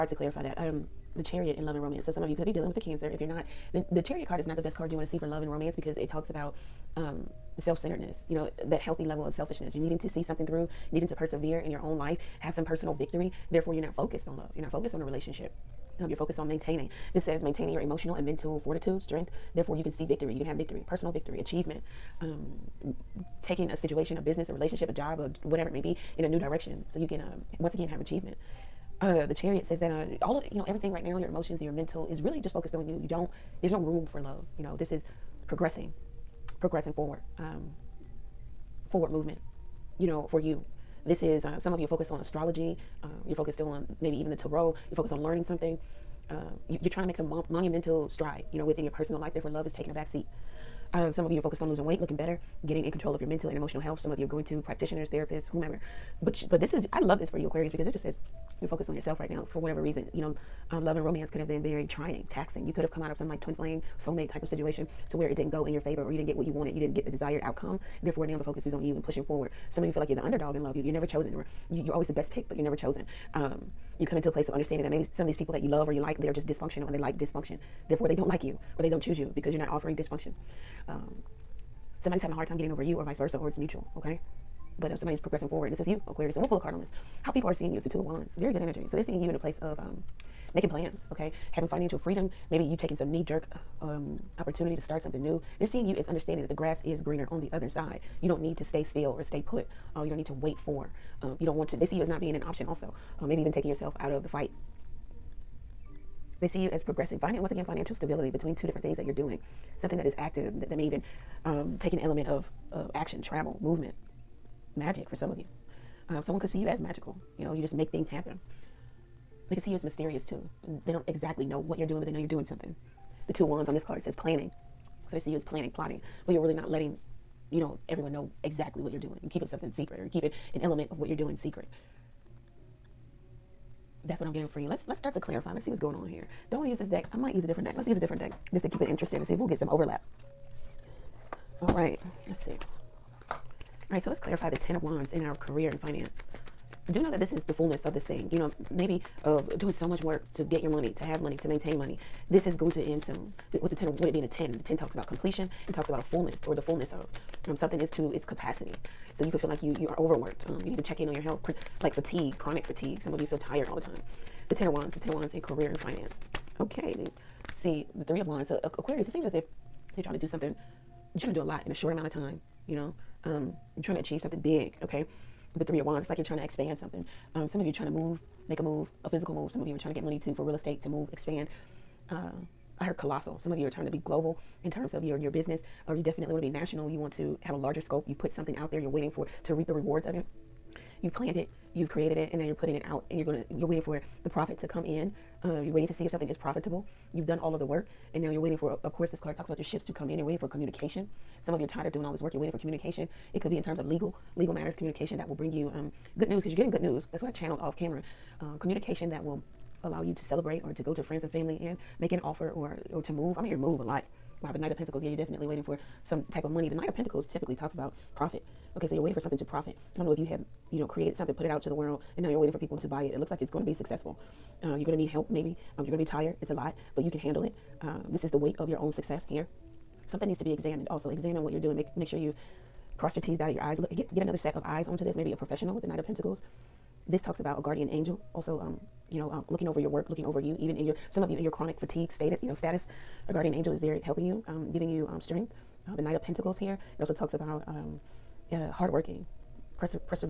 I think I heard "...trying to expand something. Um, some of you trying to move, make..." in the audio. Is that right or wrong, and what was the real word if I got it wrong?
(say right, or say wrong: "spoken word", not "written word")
right.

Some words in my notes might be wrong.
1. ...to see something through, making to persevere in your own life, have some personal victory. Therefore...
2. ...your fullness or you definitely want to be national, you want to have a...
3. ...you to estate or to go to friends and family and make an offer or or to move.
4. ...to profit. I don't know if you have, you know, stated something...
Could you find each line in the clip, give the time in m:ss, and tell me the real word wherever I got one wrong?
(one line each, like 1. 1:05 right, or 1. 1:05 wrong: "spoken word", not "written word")
1. 0:09 wrong: "needing", not "making"
2. 3:05 wrong: "business", not "fullness"
3. 3:30 wrong: "celebrate", not "estate"
4. 3:39 wrong: "created", not "stated".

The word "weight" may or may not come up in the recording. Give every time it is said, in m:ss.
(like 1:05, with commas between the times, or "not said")
0:51, 3:48.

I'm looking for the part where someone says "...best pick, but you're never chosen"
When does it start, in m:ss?
1:12.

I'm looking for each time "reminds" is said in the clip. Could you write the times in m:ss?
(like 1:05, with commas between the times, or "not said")
not said.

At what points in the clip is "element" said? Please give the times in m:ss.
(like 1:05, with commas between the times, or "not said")
1:51, 2:10.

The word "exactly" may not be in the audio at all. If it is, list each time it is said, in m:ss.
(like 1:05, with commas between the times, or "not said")
2:01, 2:08.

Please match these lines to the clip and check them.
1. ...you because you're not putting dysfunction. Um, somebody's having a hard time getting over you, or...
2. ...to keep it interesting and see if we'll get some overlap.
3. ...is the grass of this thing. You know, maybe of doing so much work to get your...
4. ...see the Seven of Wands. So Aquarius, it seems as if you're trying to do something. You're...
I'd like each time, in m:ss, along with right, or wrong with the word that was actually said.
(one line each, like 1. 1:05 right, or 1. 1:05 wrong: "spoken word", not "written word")
1. 1:19 wrong: "offering", not "putting"
2. 2:18 right
3. 2:27 wrong: "fullness", not "grass"
4. 2:47 wrong: "Three", not "Seven".